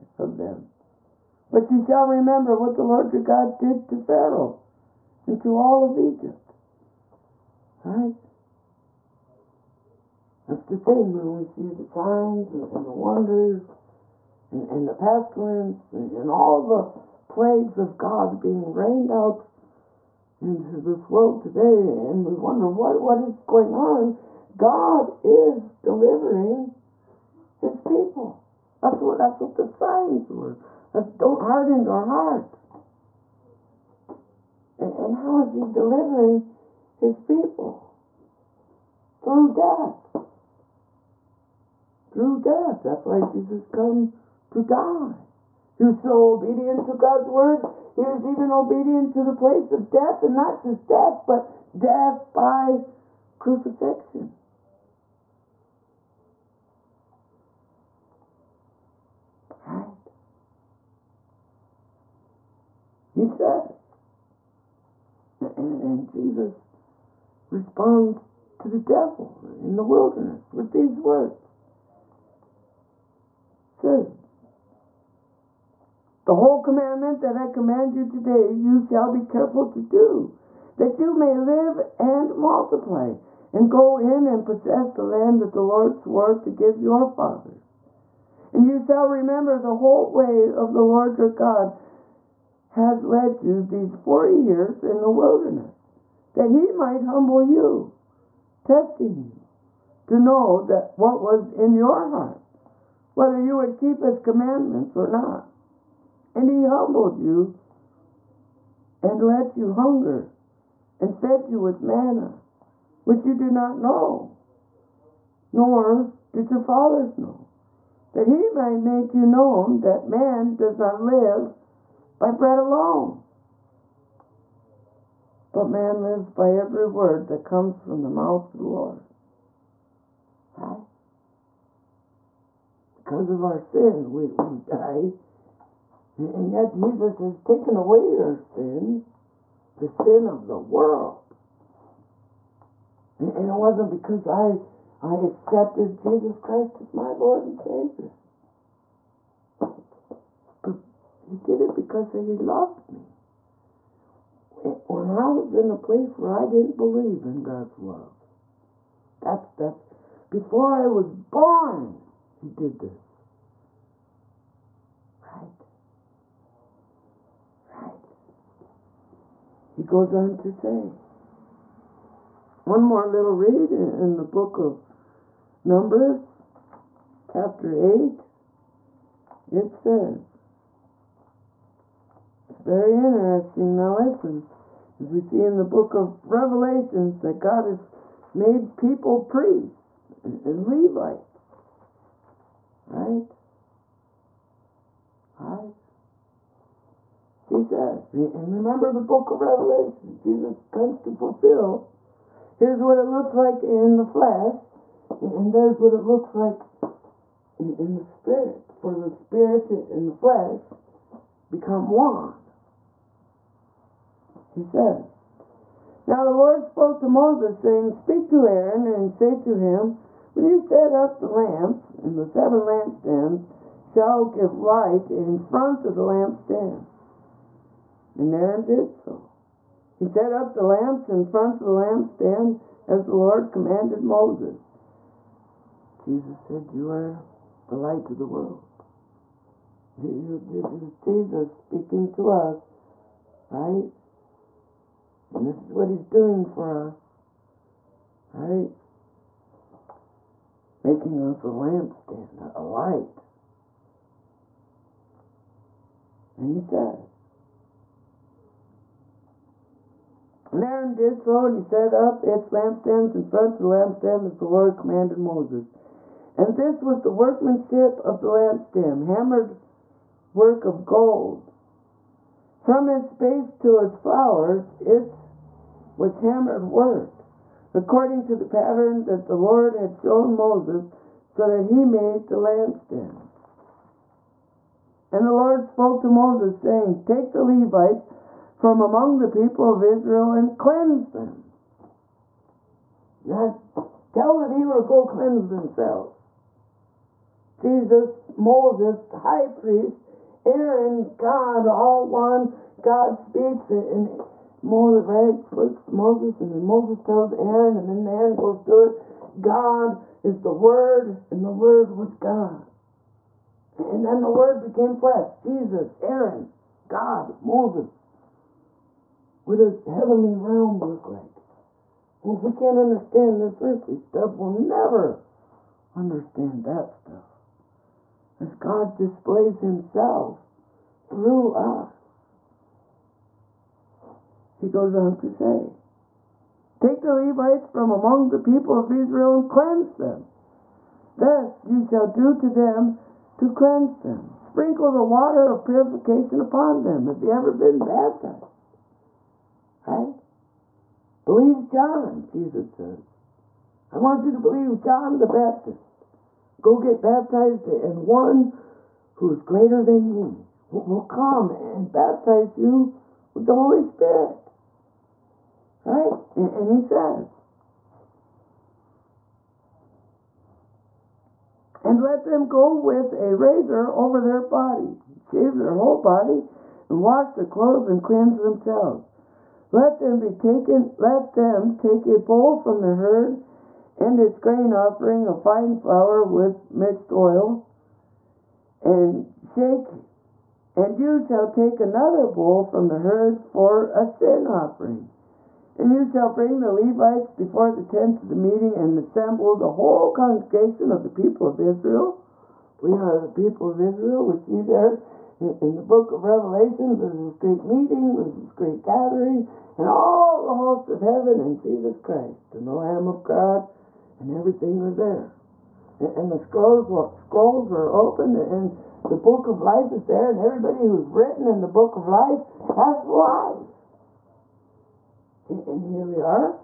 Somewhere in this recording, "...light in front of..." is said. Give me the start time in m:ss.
3:44.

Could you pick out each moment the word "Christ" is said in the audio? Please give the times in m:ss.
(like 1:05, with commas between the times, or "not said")
2:26, 6:51.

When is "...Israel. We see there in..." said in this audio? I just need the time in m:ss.
6:43.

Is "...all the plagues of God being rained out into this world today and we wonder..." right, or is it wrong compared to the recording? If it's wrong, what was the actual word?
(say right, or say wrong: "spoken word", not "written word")
right.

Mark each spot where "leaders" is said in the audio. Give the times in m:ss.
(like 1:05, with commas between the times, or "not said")
not said.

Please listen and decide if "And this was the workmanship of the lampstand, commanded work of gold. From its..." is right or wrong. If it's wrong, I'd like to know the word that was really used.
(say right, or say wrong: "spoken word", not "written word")
wrong: "hammered", not "commanded".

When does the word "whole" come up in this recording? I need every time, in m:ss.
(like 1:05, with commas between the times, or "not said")
1:16, 1:29, 6:15, 6:39.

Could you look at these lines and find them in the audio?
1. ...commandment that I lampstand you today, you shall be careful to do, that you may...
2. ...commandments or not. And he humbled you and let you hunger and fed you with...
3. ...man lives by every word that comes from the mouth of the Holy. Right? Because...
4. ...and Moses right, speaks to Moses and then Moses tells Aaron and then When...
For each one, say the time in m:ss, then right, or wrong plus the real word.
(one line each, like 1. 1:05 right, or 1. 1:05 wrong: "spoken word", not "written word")
1. 1:16 wrong: "command", not "lampstand"
2. 1:44 right
3. 2:05 wrong: "Lord", not "Holy"
4. 5:04 wrong: "Aaron", not "When".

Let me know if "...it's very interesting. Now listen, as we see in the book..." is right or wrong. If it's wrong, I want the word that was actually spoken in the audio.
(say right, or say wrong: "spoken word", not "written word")
right.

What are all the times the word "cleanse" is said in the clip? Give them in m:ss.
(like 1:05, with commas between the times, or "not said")
4:50, 4:55, 5:39, 5:43, 6:18.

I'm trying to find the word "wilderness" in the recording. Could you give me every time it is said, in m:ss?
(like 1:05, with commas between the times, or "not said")
1:09, 1:35.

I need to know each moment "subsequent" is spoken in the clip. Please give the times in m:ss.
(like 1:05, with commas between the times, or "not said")
not said.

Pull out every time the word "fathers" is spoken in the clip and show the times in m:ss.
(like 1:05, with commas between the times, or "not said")
1:27, 1:56.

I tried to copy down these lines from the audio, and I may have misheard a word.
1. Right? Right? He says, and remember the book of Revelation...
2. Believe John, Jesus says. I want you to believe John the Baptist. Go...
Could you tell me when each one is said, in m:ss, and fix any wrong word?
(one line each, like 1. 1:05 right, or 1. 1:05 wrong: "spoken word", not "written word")
1. 3:12 right
2. 5:51 right.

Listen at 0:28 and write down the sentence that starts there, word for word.
That's what that's what the signs were.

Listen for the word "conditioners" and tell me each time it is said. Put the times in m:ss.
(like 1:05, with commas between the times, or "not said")
not said.